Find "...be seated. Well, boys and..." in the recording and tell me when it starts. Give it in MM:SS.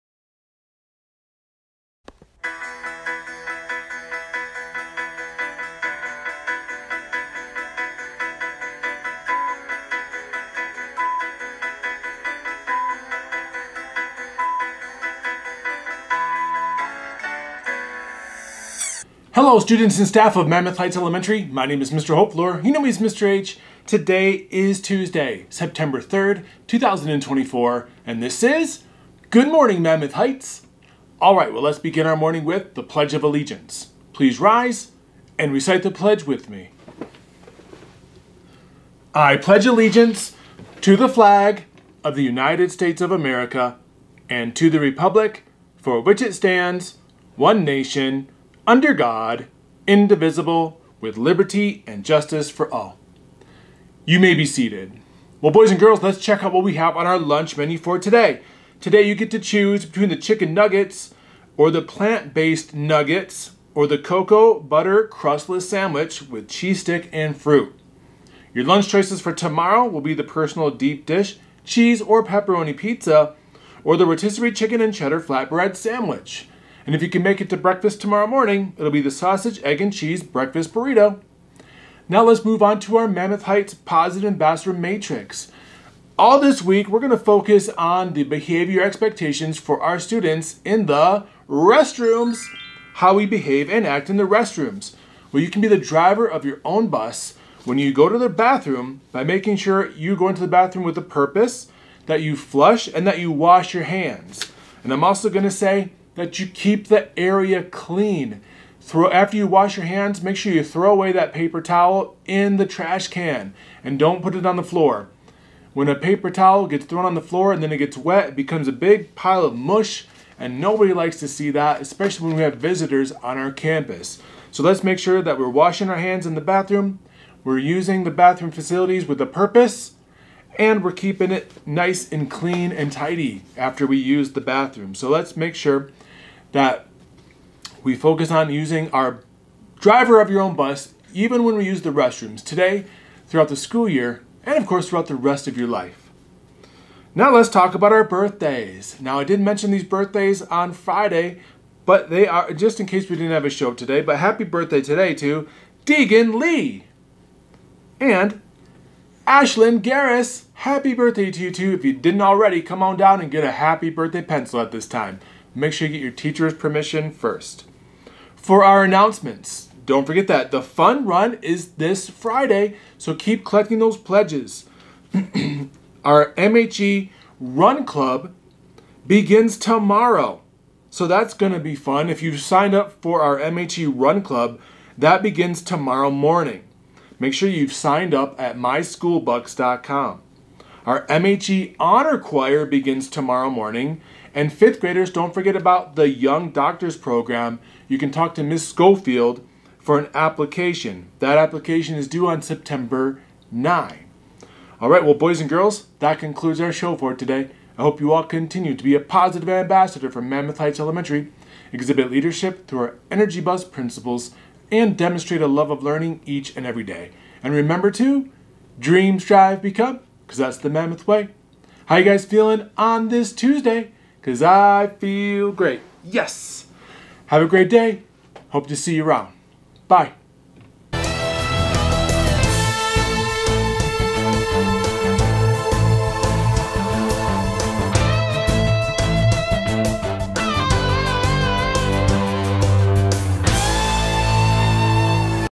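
00:54.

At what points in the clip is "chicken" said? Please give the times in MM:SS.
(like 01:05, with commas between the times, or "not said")
01:00, 01:14.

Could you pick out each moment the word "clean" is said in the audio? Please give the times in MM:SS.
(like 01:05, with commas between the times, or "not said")
01:47, 02:12.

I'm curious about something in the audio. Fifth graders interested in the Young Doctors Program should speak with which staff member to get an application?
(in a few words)
Ms. Schofield.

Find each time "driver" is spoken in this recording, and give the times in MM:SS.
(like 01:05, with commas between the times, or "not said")
01:35, 02:19.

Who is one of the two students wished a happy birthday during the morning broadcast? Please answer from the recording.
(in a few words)
Deegan Lee.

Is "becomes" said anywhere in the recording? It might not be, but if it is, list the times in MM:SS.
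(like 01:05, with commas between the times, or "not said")
01:58, 03:39.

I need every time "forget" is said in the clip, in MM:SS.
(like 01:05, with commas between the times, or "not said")
02:50, 03:15.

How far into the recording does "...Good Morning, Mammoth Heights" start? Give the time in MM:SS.
00:29.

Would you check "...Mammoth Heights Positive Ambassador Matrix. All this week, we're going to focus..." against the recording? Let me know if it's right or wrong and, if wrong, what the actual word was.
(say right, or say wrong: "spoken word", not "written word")
right.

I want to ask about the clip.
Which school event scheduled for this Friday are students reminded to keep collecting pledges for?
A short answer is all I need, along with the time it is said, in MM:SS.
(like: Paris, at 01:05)
fun run, at 02:50.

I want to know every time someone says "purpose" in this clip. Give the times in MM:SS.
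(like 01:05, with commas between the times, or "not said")
01:41, 02:09.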